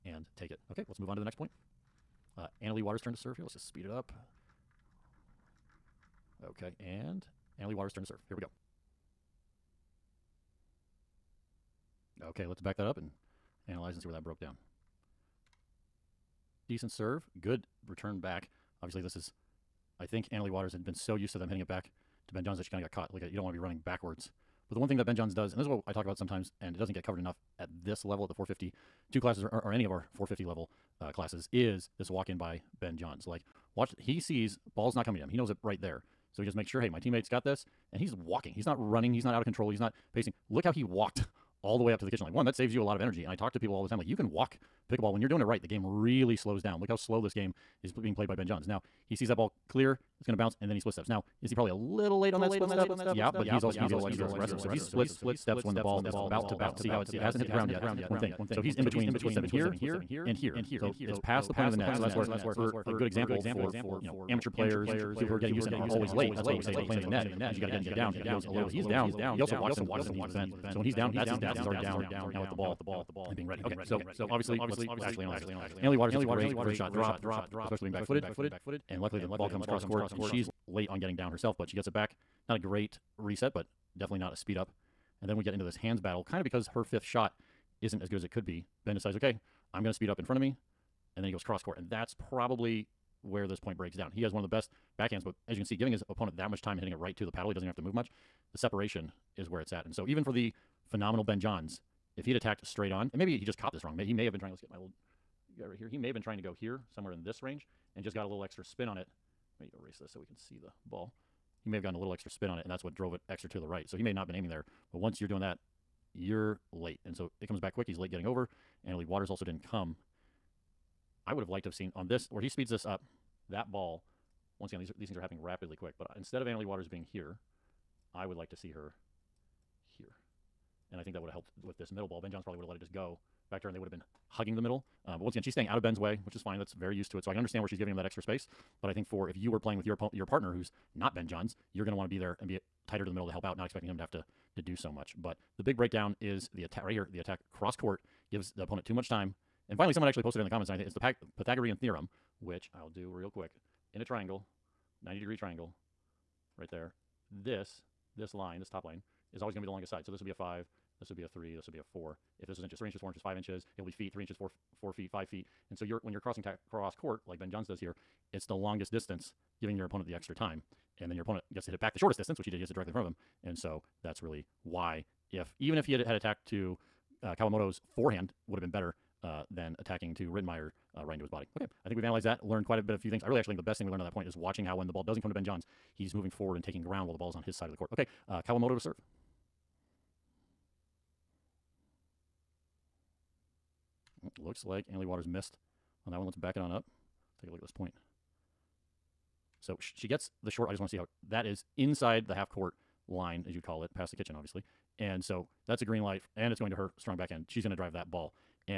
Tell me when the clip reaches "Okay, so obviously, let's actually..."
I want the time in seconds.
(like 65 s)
73 s.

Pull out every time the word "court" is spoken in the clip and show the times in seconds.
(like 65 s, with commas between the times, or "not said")
79 s, 91 s, 147 s, 166 s, 187 s, 202 s.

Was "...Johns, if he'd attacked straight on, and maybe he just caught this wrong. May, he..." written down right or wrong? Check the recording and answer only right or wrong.
right.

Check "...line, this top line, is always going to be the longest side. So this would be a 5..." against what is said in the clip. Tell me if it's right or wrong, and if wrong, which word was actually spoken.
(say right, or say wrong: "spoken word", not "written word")
right.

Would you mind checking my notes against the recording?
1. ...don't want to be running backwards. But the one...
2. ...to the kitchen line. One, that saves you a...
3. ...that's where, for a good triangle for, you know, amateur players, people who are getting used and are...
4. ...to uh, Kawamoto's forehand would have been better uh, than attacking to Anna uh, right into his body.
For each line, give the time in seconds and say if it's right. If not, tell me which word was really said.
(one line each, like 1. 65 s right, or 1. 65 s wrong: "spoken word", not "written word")
1. 23 s right
2. 41 s right
3. 62 s wrong: "example", not "triangle"
4. 176 s wrong: "Rettenmaier", not "Anna".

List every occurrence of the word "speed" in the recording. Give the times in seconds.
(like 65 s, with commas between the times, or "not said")
3 s, 84 s, 89 s, 122 s.